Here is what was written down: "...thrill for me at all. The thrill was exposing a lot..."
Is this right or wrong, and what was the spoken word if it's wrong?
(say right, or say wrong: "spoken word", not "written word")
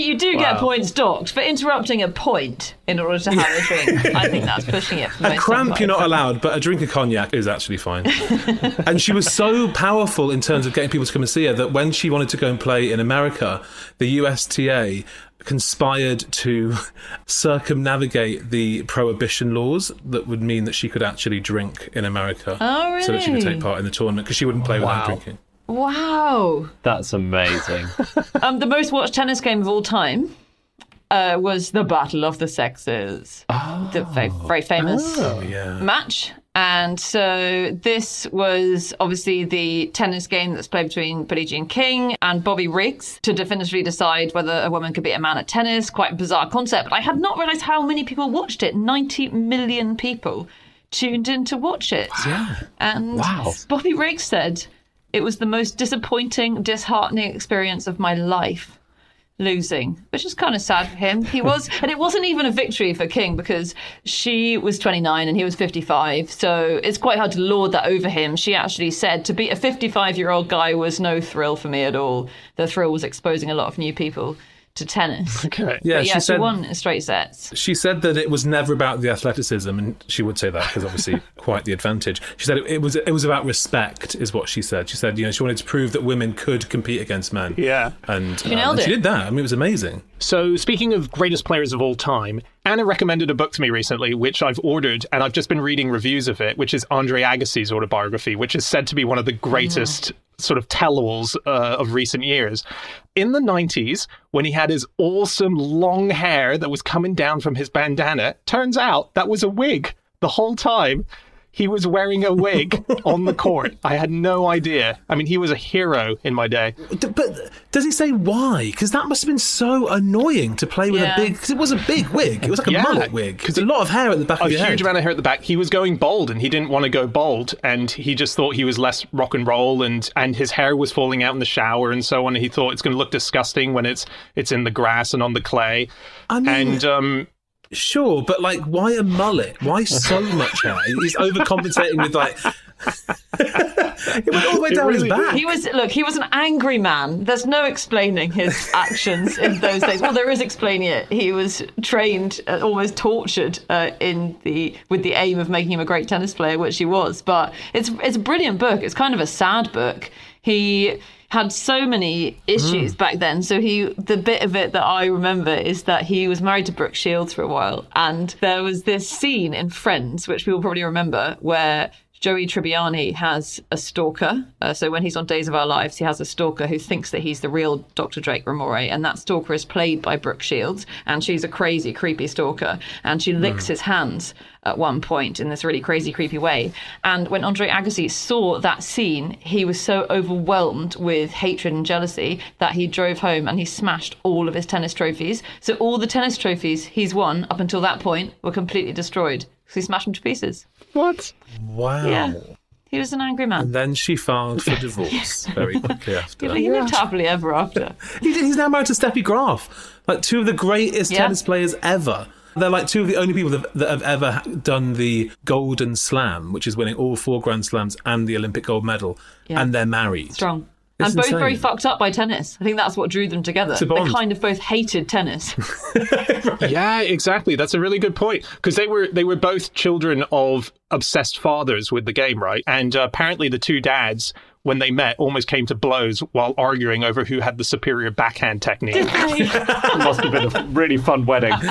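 right.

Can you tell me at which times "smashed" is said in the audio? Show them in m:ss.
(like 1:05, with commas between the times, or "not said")
3:13, 3:19.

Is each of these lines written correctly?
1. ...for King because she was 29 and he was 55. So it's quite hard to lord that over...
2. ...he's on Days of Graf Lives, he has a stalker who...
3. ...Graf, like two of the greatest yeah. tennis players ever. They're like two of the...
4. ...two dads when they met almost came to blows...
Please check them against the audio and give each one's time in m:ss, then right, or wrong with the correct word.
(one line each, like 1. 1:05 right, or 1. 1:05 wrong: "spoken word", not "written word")
1. 1:02 right
2. 2:55 wrong: "Our", not "Graf"
3. 3:29 right
4. 3:53 right.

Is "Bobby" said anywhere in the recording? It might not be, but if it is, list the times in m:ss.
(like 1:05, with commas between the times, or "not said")
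0:42, 0:53.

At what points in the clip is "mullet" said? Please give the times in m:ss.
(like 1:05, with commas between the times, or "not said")
2:02, 2:19.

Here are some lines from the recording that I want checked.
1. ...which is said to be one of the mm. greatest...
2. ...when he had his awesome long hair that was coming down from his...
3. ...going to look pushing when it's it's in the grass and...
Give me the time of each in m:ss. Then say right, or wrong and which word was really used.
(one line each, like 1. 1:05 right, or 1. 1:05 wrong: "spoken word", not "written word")
1. 1:38 right
2. 1:44 right
3. 2:12 wrong: "disgusting", not "pushing".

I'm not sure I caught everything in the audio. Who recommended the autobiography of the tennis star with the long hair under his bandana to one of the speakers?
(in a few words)
Anna.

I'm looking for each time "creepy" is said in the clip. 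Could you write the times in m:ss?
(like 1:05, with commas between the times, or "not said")
3:01, 3:06.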